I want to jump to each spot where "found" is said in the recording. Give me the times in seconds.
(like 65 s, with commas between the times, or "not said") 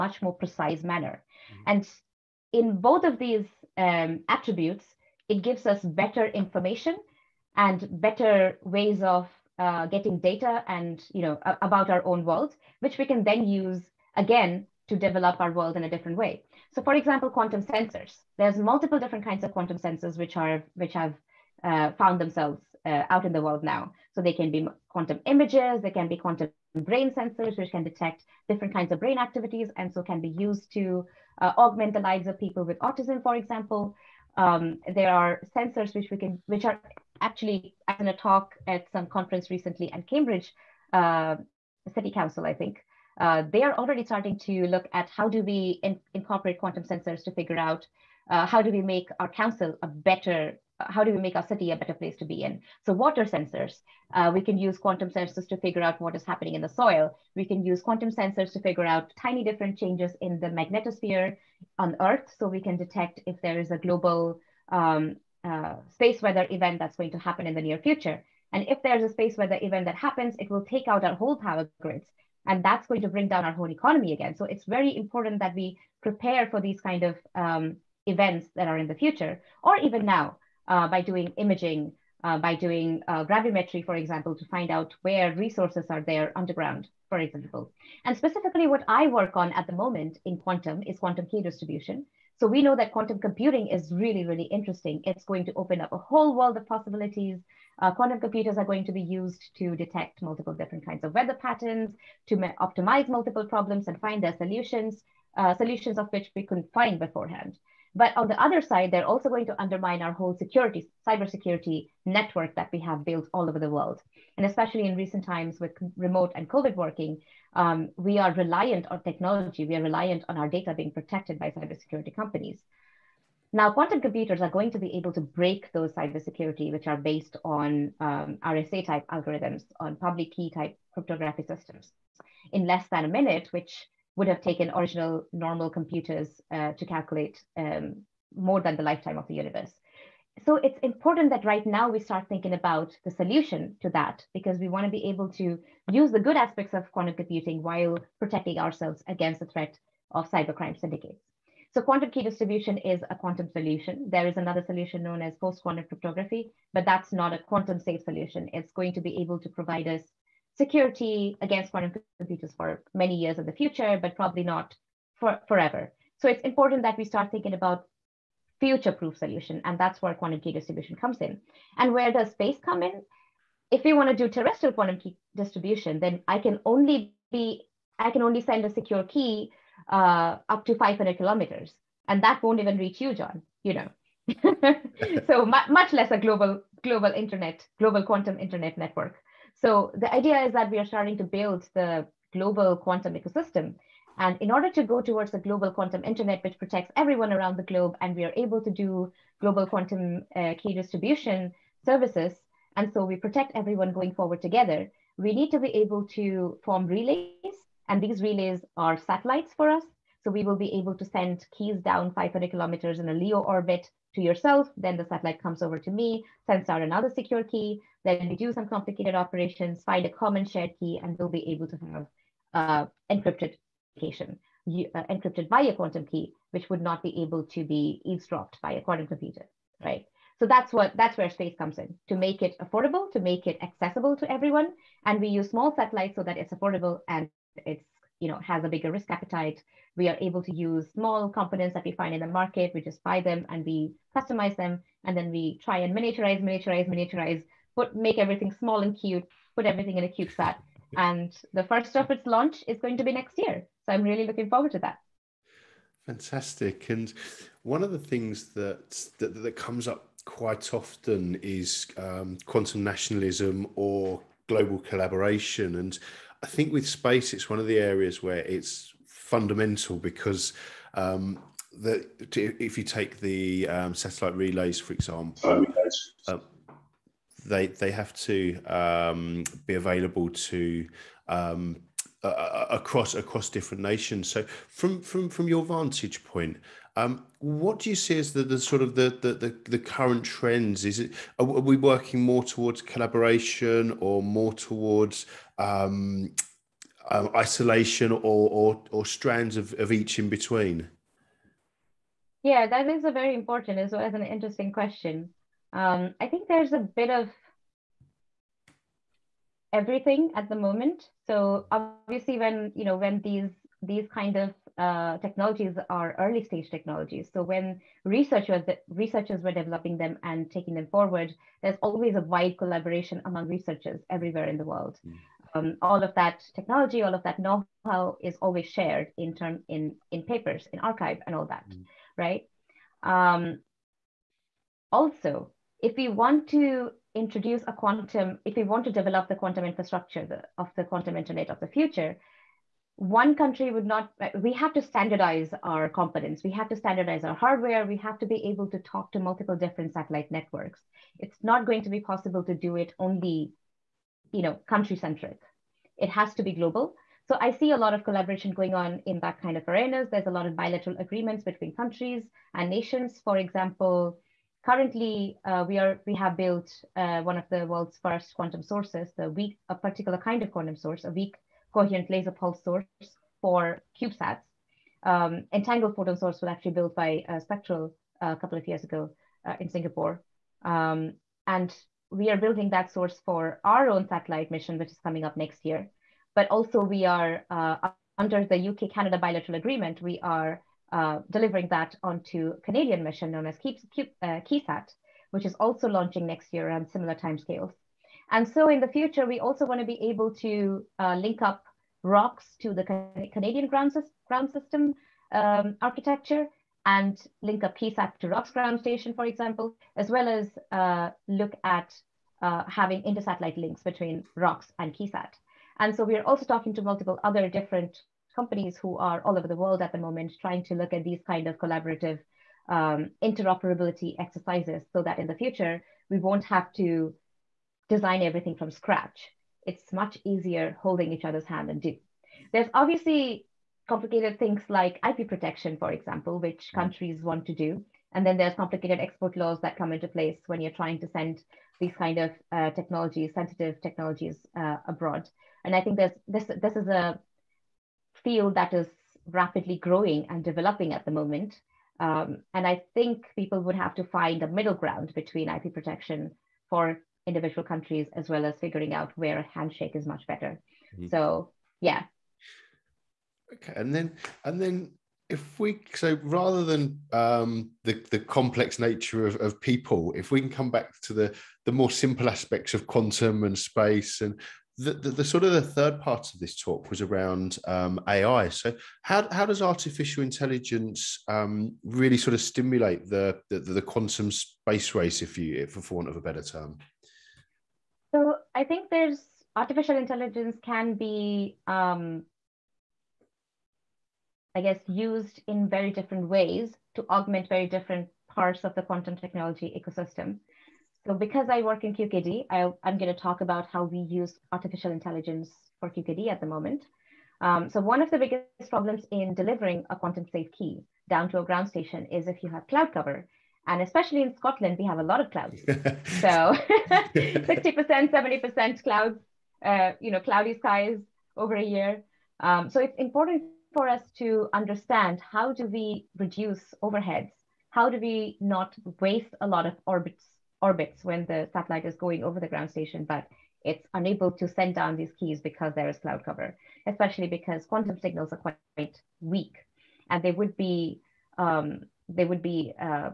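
21 s.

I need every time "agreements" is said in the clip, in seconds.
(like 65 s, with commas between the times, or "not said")
360 s, 389 s.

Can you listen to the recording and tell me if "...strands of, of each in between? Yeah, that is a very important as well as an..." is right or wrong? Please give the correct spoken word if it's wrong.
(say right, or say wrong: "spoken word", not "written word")
right.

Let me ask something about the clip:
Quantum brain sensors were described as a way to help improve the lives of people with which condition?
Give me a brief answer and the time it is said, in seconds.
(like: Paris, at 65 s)
Autism, at 32 s.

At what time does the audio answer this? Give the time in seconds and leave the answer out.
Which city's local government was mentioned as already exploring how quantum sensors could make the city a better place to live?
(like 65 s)
40 s.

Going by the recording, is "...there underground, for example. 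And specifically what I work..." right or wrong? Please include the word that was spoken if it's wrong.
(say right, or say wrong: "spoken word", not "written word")
right.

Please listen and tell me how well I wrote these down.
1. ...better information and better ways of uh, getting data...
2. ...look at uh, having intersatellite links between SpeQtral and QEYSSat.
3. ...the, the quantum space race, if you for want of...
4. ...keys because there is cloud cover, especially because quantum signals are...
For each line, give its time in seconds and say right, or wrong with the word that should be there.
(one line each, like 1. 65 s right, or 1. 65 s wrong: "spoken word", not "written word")
1. 5 s right
2. 411 s wrong: "ROKS", not "SpeQtral"
3. 483 s right
4. 535 s right.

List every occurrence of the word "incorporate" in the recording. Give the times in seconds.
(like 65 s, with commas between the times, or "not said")
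46 s.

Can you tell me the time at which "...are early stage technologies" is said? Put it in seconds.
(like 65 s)
315 s.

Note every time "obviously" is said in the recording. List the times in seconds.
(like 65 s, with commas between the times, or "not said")
311 s, 432 s.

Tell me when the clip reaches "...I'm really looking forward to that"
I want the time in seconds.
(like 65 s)
253 s.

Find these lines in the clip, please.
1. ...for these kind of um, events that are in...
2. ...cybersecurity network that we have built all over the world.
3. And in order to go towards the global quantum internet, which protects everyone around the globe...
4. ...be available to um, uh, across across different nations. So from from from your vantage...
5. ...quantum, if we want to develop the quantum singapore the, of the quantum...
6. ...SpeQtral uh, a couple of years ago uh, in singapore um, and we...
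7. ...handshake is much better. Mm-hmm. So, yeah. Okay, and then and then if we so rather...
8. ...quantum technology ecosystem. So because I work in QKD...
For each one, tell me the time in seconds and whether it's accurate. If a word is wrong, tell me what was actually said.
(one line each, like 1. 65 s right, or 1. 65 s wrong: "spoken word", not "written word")
1. 76 s right
2. 111 s right
3. 194 s right
4. 279 s right
5. 337 s wrong: "infrastructure", not "singapore"
6. 377 s right
7. 459 s right
8. 498 s right.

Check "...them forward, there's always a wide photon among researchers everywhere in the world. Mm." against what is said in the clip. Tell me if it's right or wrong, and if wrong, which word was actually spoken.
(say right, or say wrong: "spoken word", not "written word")
wrong: "collaboration", not "photon".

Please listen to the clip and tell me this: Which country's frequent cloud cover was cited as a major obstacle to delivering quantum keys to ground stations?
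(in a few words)
Scotland.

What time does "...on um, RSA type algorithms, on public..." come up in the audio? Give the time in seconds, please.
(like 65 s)
127 s.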